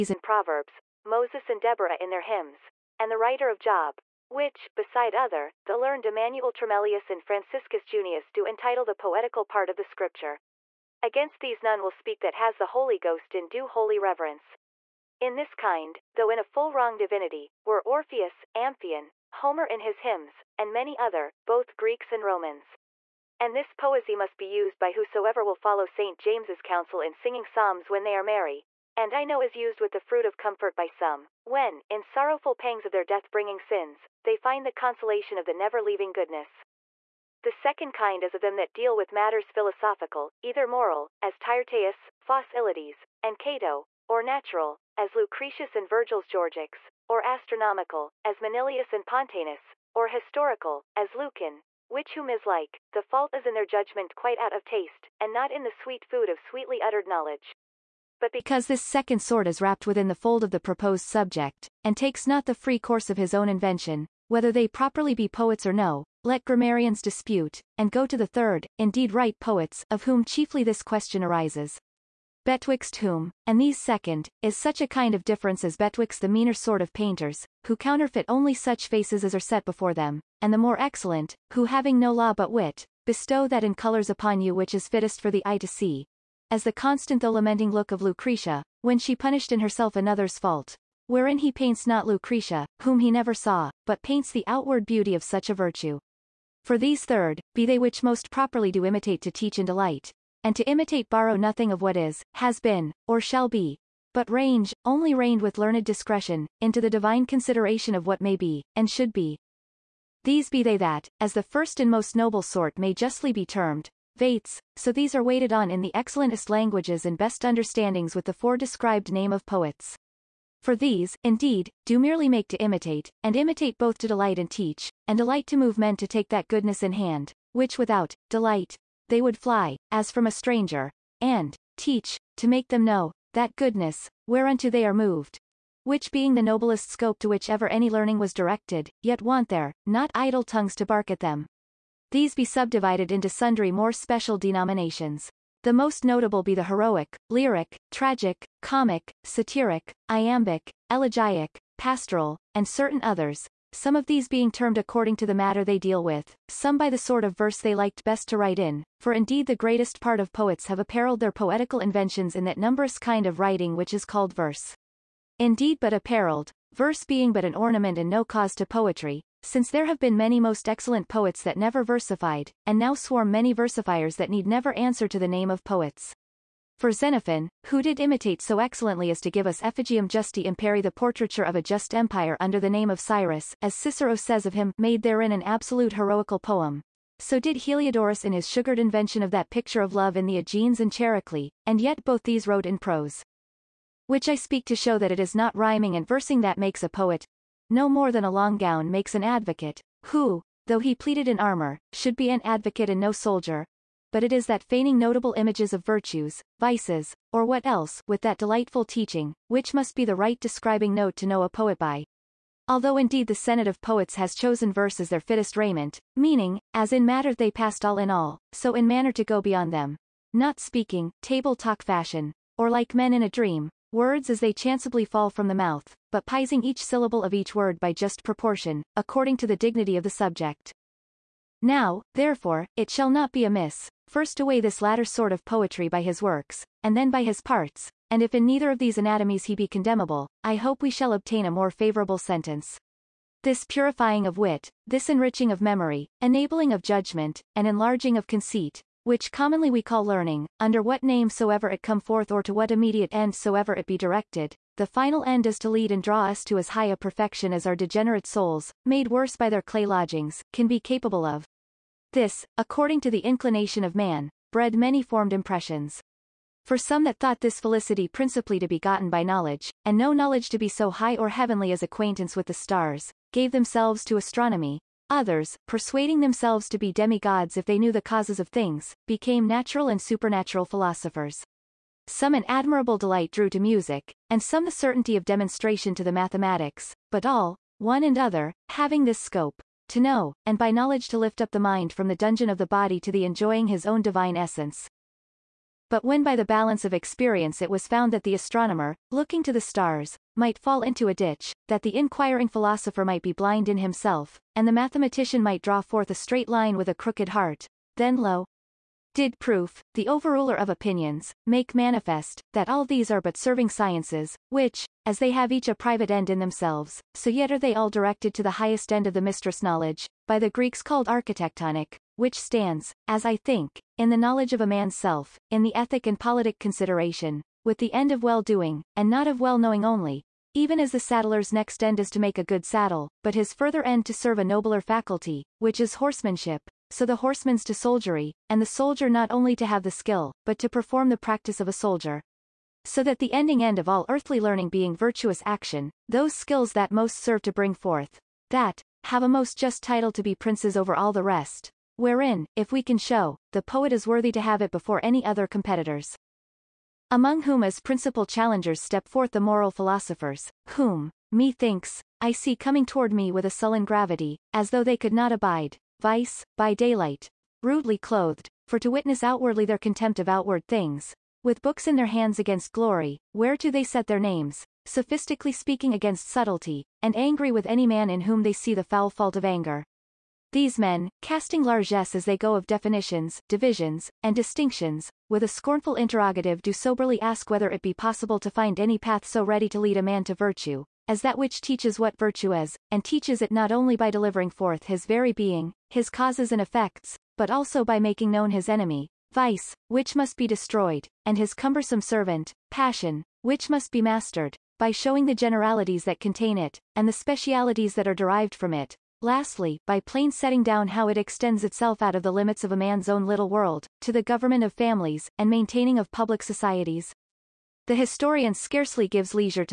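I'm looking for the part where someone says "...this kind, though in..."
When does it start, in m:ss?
0:15.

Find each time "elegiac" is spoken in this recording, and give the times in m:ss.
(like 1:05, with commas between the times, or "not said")
2:30.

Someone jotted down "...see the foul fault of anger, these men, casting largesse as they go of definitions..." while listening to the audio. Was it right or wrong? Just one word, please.
right.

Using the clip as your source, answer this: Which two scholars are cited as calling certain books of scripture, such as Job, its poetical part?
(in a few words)
Emmanuel Tremellius and Franciscus Junius.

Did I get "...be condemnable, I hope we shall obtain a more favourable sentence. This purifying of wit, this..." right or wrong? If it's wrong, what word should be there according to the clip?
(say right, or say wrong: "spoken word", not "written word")
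right.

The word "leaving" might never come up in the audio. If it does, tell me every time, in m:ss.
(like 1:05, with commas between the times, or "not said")
0:35.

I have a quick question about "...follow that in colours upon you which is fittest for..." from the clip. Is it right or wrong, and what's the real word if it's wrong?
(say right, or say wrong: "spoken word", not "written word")
wrong: "bestow", not "follow".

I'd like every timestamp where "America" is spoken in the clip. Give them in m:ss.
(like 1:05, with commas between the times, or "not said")
not said.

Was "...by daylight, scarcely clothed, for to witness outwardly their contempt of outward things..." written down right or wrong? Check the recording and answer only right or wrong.
wrong.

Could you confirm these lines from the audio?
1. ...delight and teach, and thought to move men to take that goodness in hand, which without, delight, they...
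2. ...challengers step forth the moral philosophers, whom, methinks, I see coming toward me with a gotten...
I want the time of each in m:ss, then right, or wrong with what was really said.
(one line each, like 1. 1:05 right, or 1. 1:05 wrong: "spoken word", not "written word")
1. 2:04 wrong: "delight", not "thought"
2. 5:58 wrong: "sullen", not "gotten".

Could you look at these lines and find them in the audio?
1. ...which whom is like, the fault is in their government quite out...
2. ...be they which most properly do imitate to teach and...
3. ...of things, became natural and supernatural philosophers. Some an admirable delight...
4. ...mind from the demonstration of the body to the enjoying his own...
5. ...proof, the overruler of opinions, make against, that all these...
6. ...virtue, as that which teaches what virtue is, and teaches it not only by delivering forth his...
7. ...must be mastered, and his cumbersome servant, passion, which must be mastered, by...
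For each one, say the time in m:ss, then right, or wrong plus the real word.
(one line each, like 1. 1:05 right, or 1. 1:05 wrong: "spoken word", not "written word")
1. 0:51 wrong: "judgment", not "government"
2. 1:37 right
3. 4:38 right
4. 4:51 wrong: "dungeon", not "demonstration"
5. 5:09 wrong: "manifest", not "against"
6. 6:30 right
7. 6:40 wrong: "destroyed", not "mastered".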